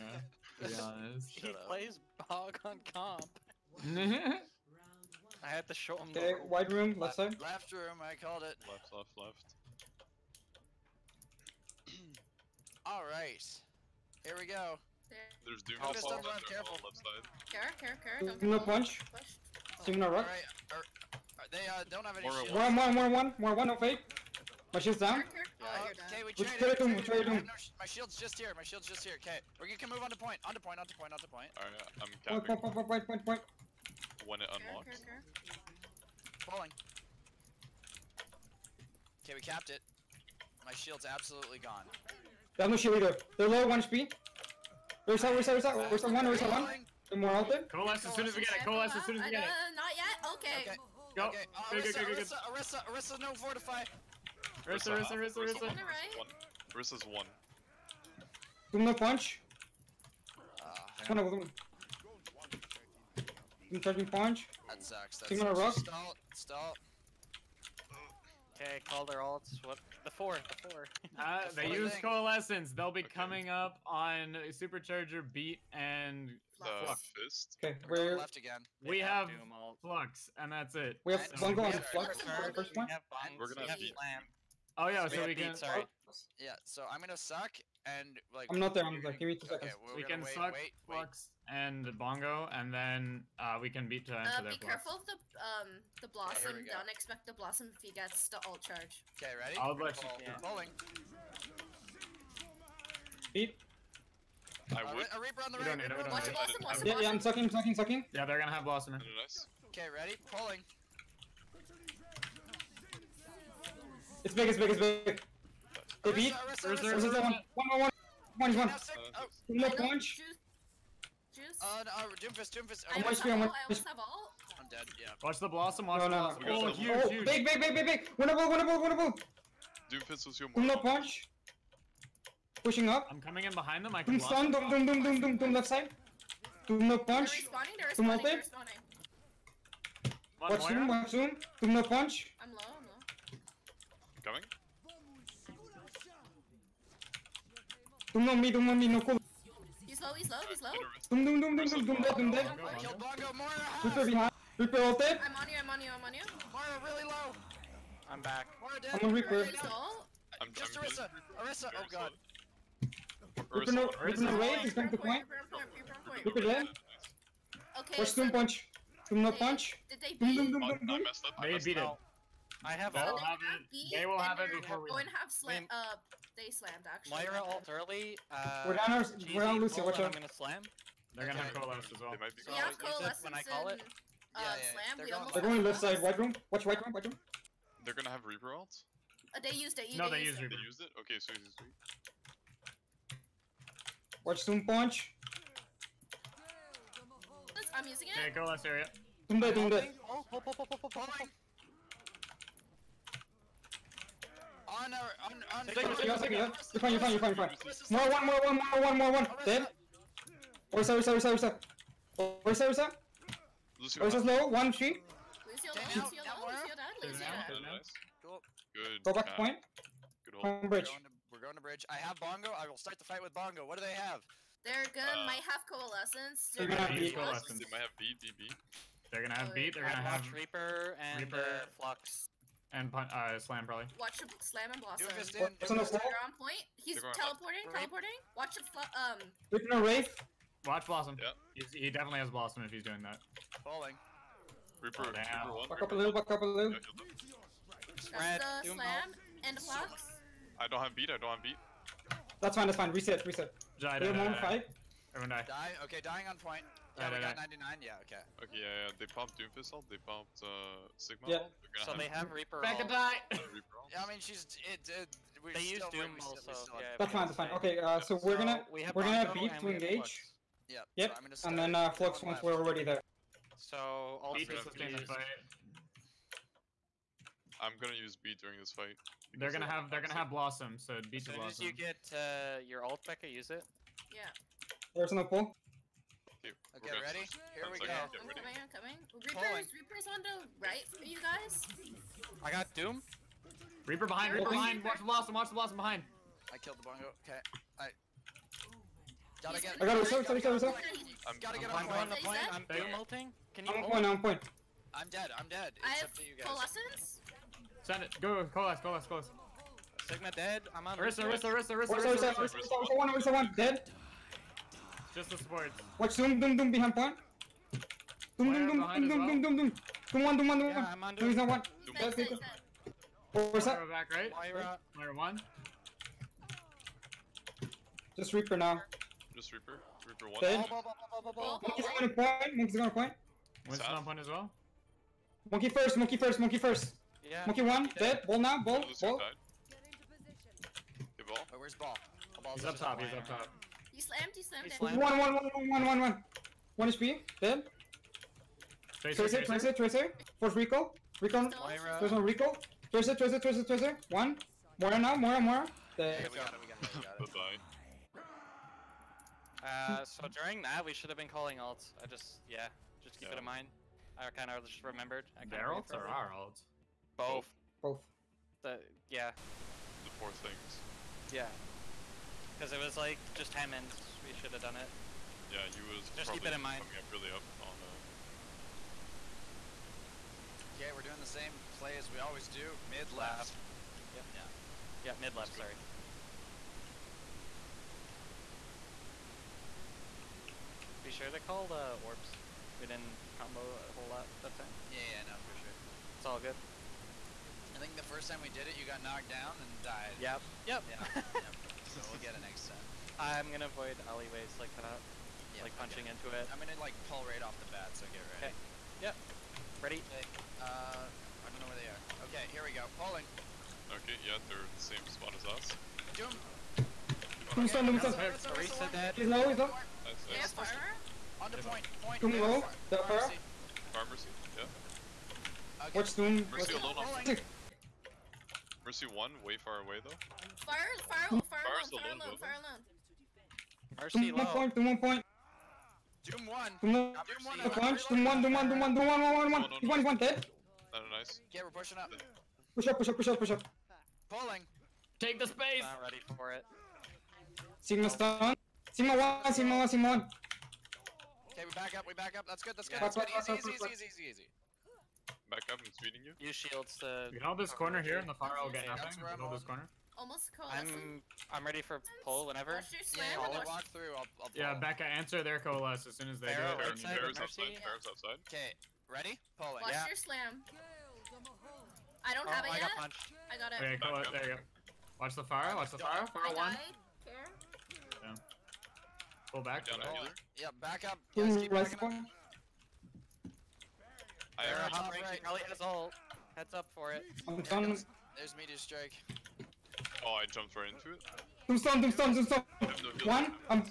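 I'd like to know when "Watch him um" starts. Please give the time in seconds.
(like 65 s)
238 s.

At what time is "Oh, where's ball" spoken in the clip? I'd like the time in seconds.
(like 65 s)
341 s.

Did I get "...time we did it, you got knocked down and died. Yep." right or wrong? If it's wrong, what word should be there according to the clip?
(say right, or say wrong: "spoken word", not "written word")
right.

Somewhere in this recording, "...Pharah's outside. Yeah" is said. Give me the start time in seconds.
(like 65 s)
467 s.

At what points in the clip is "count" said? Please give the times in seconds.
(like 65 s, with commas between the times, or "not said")
not said.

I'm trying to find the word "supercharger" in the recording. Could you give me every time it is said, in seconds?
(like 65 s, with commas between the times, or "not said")
74 s.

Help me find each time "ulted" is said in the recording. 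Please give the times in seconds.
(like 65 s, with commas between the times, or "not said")
154 s.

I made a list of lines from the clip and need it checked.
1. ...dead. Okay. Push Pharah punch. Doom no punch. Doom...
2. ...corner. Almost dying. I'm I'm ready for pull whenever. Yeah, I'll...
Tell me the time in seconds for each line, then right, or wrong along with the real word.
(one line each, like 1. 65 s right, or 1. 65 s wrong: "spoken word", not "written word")
1. 166 s wrong: "Doom", not "Pharah"
2. 459 s wrong: "coalescing", not "dying".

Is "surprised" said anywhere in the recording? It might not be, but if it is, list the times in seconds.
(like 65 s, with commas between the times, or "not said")
not said.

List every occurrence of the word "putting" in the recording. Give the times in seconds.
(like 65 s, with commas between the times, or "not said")
not said.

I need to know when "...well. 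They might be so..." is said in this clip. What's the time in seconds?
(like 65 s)
182 s.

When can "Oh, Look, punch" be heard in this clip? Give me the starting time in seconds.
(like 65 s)
119 s.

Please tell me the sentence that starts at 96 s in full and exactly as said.
Okay, Don't expect the Blossom if he gets the ult charge.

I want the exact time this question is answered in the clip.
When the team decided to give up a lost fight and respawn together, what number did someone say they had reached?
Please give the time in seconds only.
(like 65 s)
257 s.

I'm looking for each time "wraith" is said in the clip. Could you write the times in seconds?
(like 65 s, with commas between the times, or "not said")
239 s.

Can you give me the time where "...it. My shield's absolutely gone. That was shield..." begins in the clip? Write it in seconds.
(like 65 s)
39 s.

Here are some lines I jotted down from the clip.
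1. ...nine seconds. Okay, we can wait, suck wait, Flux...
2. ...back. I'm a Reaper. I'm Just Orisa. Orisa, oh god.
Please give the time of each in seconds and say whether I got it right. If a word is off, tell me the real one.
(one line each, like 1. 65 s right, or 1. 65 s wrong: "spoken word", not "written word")
1. 89 s wrong: "two", not "nine"
2. 158 s right.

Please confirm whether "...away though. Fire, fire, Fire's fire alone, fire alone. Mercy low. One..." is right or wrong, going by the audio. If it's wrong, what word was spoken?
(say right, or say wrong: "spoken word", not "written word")
right.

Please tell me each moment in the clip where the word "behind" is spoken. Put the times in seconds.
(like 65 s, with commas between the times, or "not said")
133 s, 154 s, 316 s.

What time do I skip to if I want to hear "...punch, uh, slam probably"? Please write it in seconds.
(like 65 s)
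232 s.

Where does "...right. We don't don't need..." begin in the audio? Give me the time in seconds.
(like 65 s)
105 s.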